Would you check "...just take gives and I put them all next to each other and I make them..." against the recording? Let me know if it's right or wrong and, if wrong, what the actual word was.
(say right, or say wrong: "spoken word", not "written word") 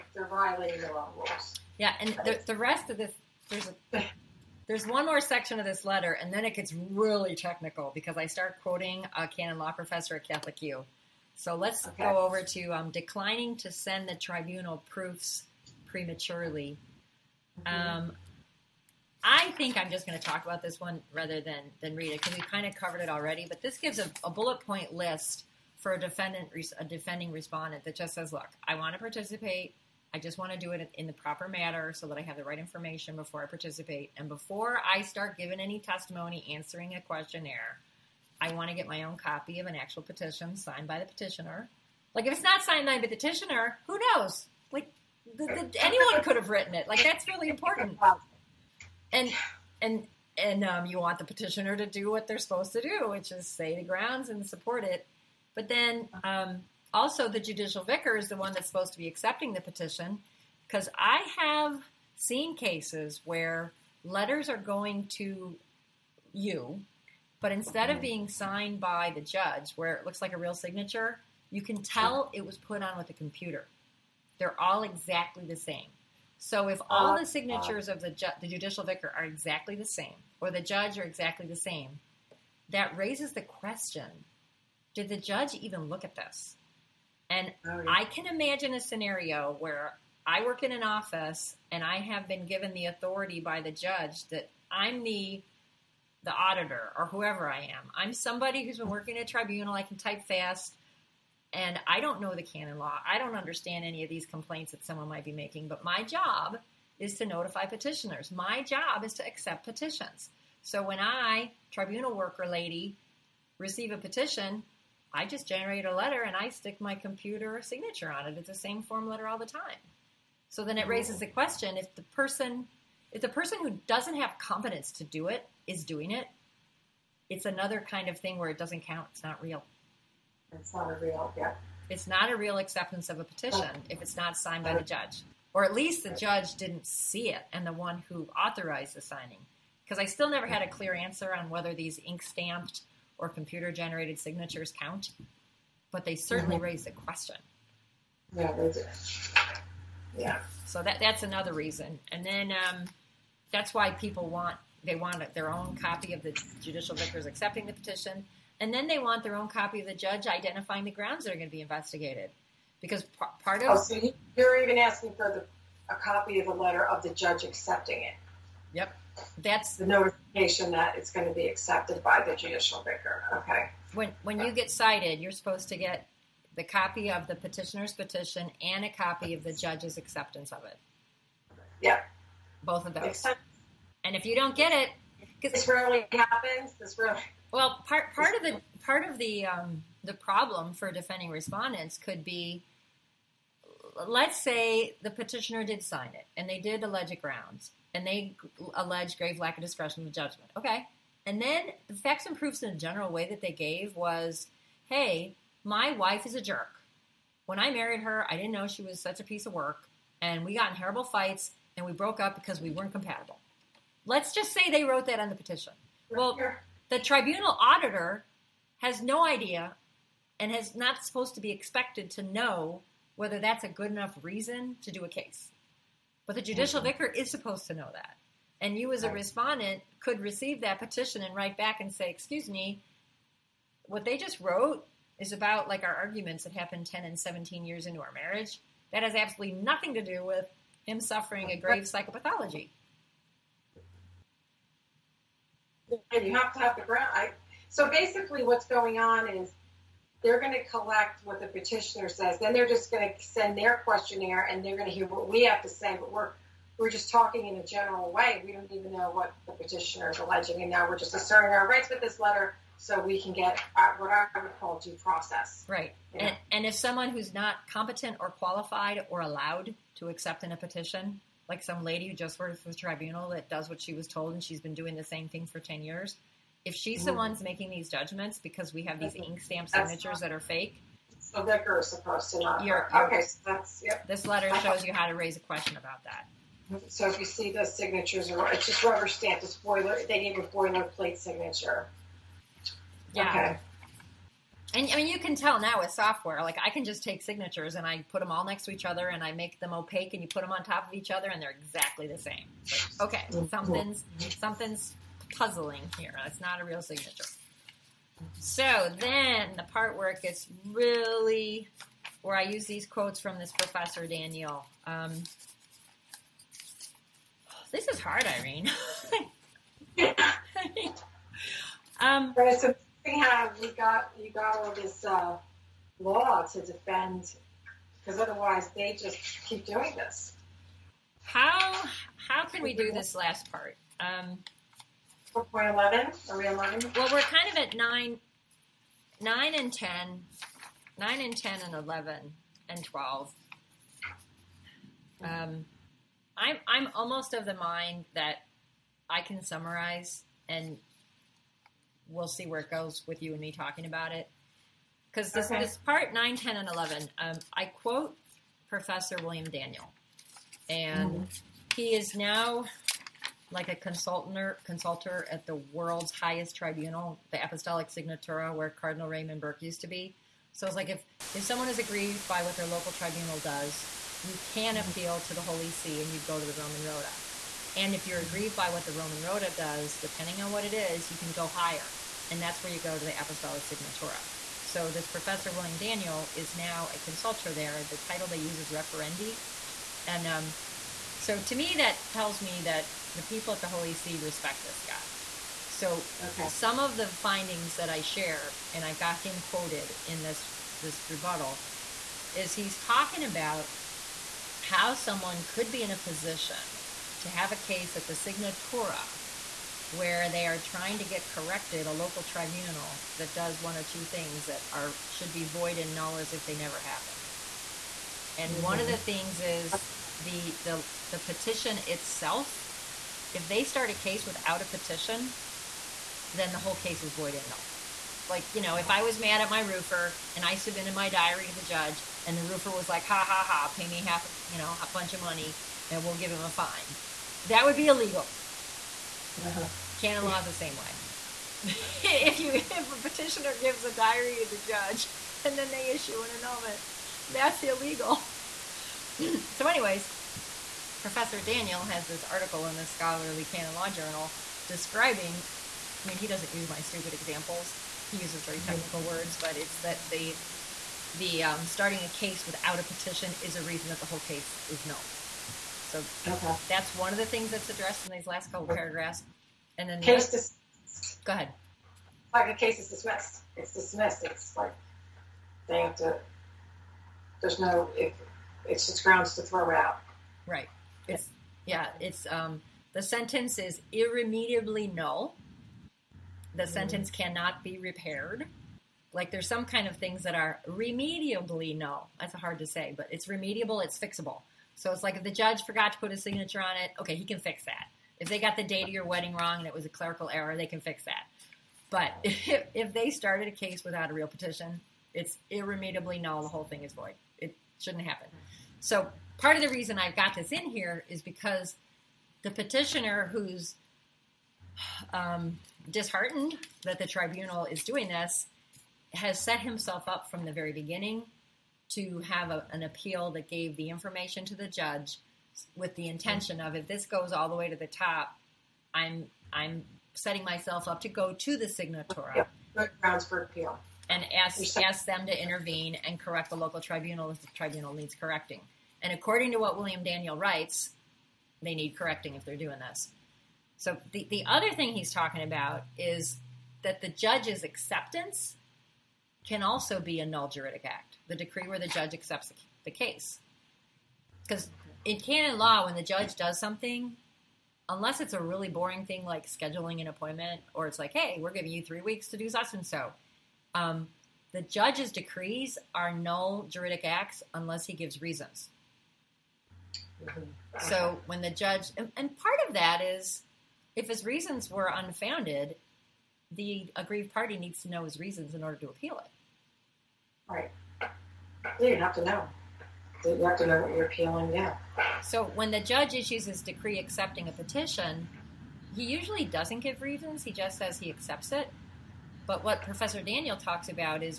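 wrong: "signatures", not "gives".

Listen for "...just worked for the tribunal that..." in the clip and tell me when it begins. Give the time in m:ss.
4:32.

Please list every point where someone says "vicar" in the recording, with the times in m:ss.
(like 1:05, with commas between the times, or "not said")
0:57, 1:18, 2:36, 2:52, 3:46.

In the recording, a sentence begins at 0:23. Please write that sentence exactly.
But this gives a, a bullet point list for a defendant, a defending respondent that just says, "Look, I want to participate.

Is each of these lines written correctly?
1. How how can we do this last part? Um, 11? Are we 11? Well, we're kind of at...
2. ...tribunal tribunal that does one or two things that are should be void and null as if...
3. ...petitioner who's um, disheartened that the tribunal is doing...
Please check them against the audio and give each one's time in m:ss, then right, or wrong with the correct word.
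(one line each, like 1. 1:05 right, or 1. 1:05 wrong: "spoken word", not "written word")
1. 5:31 right
2. 6:51 wrong: "local", not "tribunal"
3. 8:32 right.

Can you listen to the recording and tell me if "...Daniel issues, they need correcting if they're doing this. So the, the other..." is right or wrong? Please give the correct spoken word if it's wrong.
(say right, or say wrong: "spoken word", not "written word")
wrong: "writes", not "issues".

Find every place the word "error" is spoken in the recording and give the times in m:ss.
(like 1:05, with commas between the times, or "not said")
8:20.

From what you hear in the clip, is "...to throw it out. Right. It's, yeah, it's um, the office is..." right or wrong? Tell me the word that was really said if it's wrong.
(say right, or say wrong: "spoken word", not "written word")
wrong: "sentence", not "office".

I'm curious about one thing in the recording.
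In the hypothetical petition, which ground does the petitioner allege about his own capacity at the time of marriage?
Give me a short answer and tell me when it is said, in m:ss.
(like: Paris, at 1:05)
grave lack of discretion and judgment, at 3:19.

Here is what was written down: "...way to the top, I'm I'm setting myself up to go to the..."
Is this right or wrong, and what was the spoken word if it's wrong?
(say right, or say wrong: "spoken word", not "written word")
right.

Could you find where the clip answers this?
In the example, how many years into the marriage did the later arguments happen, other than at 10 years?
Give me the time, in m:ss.
3:57.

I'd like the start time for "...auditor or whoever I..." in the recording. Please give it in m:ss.
1:36.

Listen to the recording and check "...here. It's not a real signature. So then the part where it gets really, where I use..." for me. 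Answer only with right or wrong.
right.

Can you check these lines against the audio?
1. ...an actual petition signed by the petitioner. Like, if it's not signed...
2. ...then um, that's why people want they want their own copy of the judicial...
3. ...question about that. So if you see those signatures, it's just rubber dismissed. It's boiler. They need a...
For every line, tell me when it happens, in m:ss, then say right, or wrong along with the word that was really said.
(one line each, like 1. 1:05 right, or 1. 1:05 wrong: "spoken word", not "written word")
1. 0:39 right
2. 2:32 right
3. 4:45 wrong: "stamped", not "dismissed".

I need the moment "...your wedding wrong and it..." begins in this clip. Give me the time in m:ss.
8:18.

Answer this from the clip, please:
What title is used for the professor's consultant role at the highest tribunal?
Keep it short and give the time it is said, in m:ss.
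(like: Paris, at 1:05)
referendi, at 6:28.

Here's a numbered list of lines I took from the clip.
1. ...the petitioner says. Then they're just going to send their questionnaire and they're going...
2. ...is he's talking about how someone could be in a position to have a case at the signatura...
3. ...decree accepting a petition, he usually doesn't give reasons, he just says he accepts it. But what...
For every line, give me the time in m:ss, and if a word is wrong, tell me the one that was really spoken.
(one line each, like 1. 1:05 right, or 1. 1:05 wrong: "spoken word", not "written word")
1. 4:11 right
2. 6:42 right
3. 9:46 right.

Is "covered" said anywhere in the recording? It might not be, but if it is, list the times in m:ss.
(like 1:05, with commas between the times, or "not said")
0:22.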